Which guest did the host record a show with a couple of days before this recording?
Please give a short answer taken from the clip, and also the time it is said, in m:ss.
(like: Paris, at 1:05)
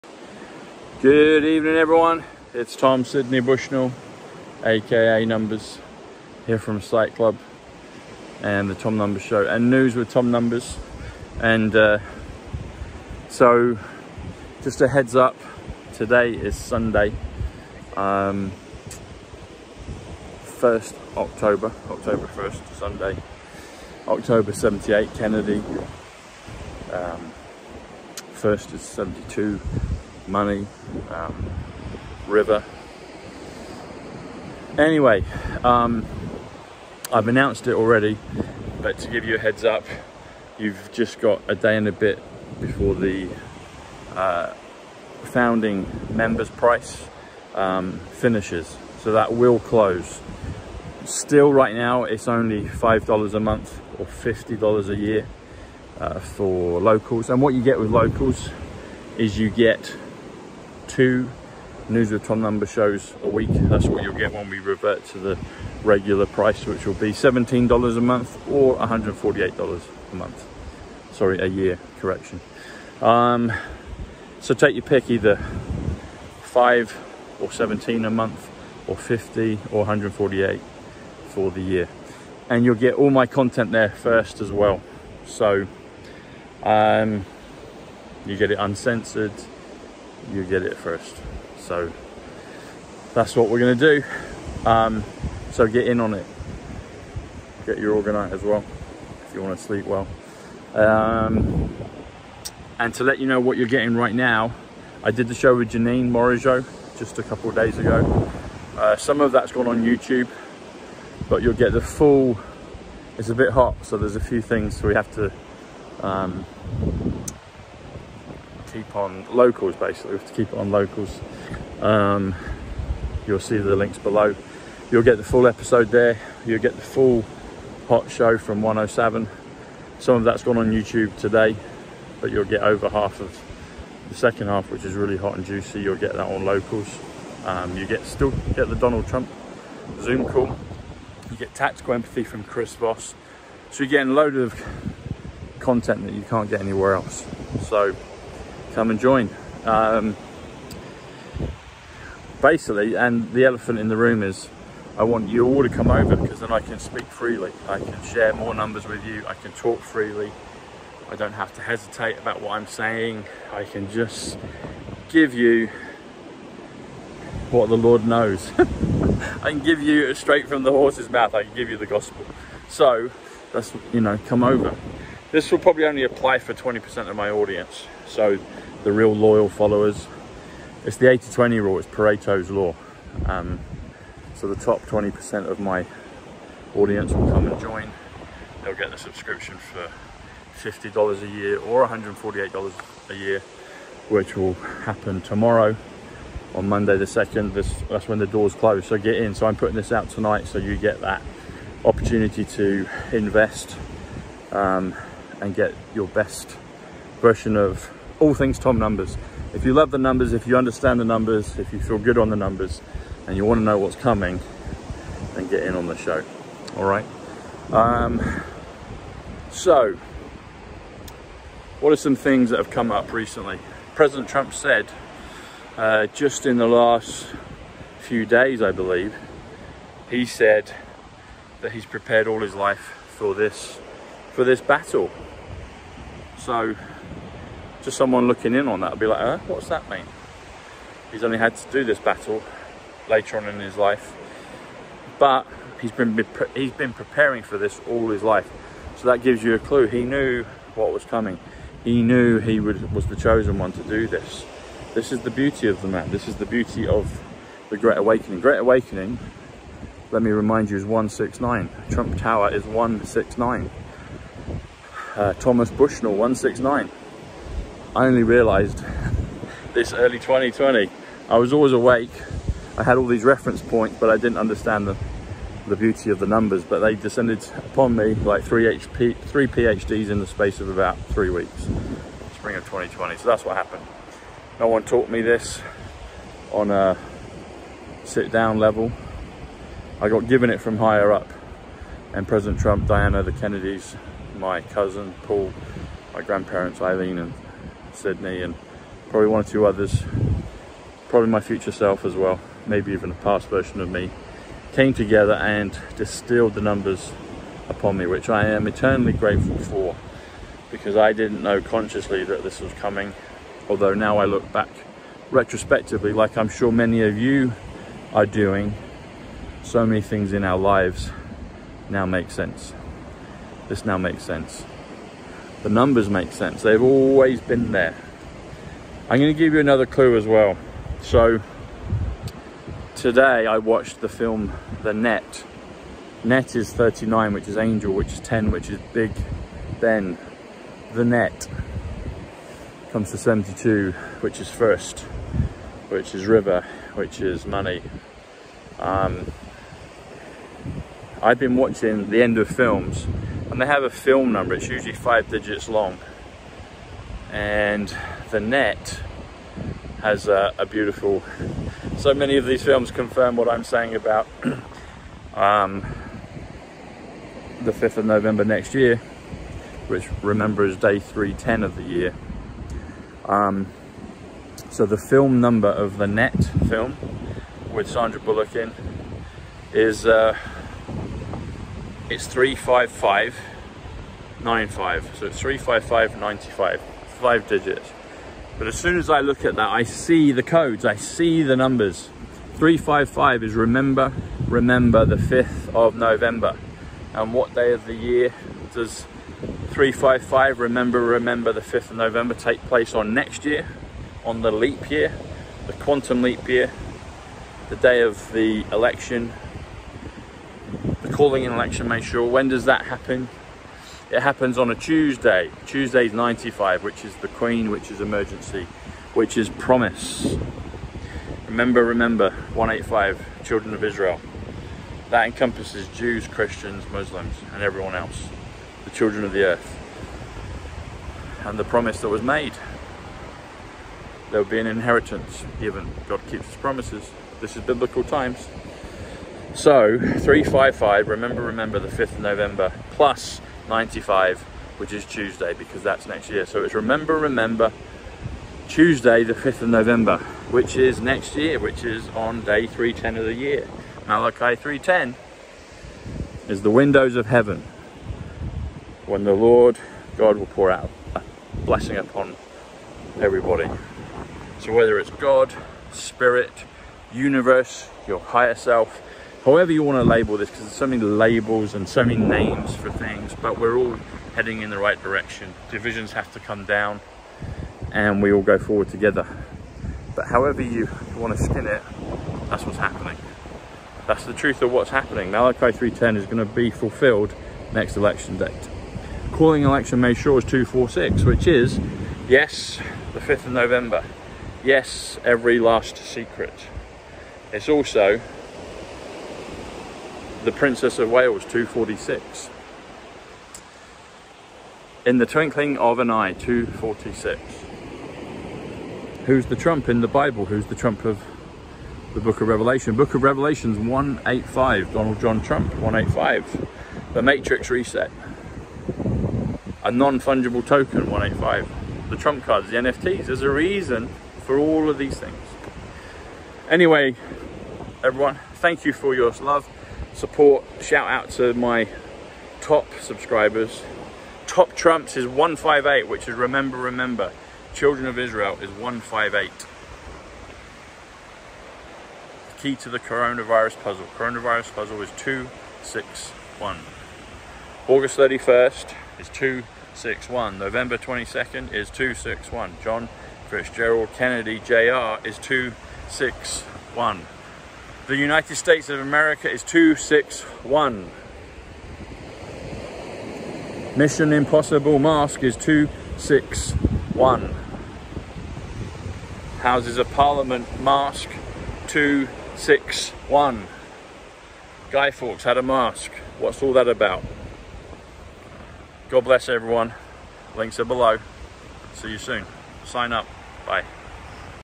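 Janine Morigeau, at 1:45.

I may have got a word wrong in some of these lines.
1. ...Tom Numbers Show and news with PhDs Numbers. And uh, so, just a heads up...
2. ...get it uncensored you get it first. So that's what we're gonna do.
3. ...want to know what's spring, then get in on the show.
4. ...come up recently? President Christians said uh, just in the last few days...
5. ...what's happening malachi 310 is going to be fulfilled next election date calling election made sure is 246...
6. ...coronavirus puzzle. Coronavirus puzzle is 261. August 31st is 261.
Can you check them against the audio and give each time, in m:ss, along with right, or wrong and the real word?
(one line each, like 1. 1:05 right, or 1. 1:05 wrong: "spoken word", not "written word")
1. 0:08 wrong: "Tom", not "PhDs"
2. 1:28 right
3. 3:33 wrong: "coming", not "spring"
4. 3:42 wrong: "Trump", not "Christians"
5. 8:04 right
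6. 9:02 right.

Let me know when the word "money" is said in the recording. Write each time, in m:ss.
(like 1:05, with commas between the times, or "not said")
0:30, 5:47.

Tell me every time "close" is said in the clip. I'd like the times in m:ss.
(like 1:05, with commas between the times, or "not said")
0:49, 3:18.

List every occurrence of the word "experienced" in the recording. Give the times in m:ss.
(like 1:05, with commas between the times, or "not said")
not said.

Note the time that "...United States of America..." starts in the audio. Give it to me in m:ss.
9:18.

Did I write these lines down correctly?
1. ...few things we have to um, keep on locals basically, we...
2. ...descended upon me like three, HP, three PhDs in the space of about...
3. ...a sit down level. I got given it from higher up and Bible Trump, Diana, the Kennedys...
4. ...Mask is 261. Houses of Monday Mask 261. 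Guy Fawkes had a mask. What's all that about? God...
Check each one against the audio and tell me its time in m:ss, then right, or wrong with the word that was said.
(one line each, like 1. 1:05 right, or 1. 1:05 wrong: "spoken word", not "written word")
1. 1:54 right
2. 4:36 right
3. 4:46 wrong: "President", not "Bible"
4. 9:24 wrong: "Parliament", not "Monday".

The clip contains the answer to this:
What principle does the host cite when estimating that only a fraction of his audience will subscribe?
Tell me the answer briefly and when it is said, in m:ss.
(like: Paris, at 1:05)
Pareto's law, at 3:01.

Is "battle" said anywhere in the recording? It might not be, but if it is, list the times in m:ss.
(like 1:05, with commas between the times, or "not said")
3:54, 4:01.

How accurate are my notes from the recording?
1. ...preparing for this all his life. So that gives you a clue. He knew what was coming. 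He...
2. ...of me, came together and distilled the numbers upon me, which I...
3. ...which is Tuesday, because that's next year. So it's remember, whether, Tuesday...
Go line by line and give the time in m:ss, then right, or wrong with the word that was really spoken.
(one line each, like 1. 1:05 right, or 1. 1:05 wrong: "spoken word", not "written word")
1. 4:06 right
2. 5:03 right
3. 7:24 wrong: "remember", not "whether".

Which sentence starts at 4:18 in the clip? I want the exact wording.
Great Awakening, let me remind you, is 169.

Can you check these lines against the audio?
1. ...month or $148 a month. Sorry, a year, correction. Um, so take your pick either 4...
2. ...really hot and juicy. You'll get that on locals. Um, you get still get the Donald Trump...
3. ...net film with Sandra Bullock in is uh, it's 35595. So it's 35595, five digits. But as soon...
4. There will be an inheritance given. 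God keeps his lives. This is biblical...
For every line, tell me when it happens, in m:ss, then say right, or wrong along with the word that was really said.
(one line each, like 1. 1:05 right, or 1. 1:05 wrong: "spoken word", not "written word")
1. 1:08 wrong: "5", not "4"
2. 2:14 right
3. 6:16 right
4. 7:14 wrong: "promises", not "lives".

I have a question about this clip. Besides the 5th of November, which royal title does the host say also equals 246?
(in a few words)
Princess of Wales.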